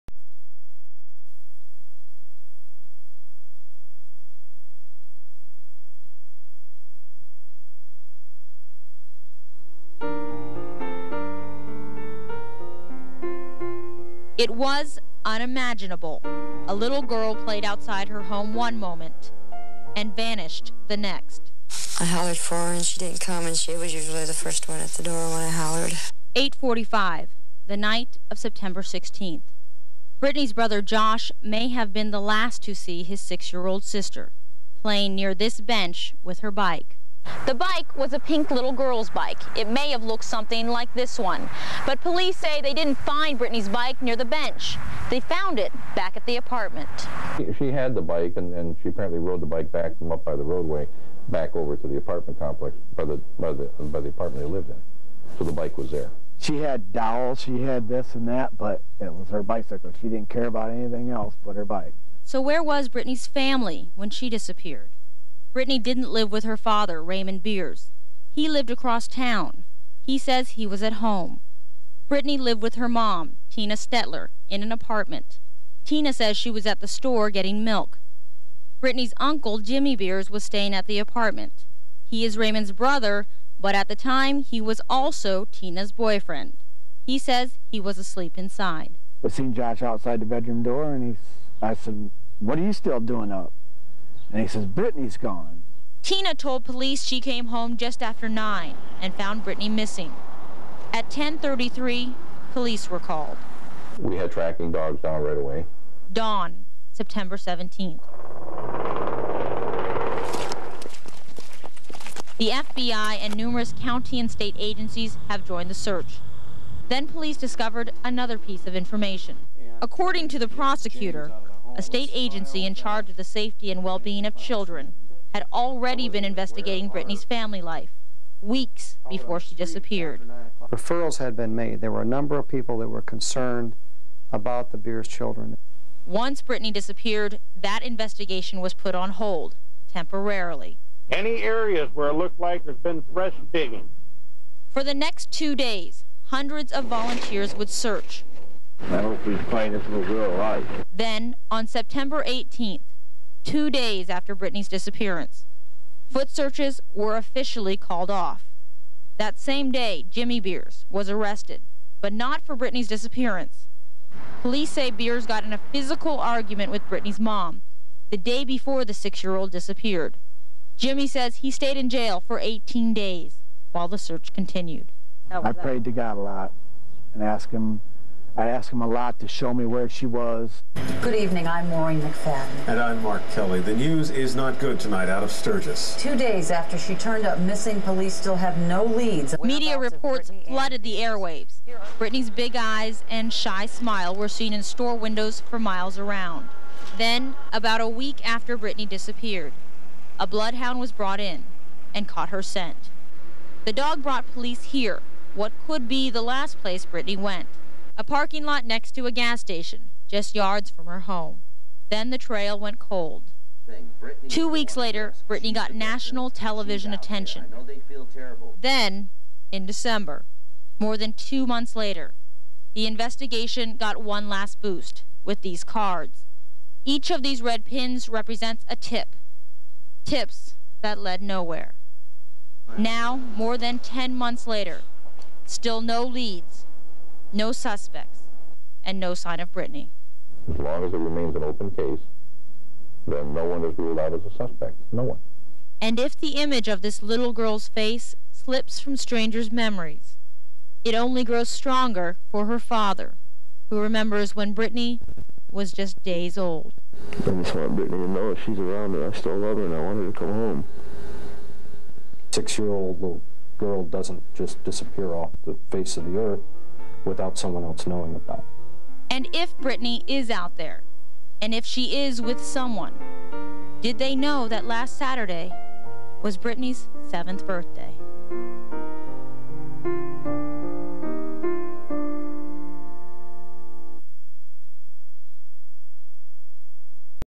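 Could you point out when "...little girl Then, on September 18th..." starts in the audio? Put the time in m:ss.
2:29.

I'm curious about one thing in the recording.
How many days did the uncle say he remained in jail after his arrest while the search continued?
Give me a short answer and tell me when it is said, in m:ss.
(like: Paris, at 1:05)
18, at 2:52.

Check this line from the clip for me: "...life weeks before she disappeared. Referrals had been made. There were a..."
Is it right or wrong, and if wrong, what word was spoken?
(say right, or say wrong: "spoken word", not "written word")
right.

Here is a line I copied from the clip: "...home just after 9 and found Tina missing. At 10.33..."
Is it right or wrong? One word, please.
wrong.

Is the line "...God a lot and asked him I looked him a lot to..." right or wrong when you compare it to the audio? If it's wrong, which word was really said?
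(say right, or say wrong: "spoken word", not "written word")
wrong: "asked", not "looked".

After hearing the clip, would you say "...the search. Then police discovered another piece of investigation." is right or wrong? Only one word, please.
wrong.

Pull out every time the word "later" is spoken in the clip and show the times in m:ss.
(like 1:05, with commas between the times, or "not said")
3:34, 3:41, 3:54.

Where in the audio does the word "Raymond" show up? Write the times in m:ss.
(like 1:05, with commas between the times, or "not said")
1:07, 1:22.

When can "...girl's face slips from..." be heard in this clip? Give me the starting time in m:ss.
4:07.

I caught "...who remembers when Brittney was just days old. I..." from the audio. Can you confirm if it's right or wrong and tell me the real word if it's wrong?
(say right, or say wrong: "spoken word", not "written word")
right.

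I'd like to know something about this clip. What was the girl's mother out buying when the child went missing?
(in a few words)
Milk.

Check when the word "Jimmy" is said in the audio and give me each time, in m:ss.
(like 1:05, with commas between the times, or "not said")
1:19, 2:40, 2:50.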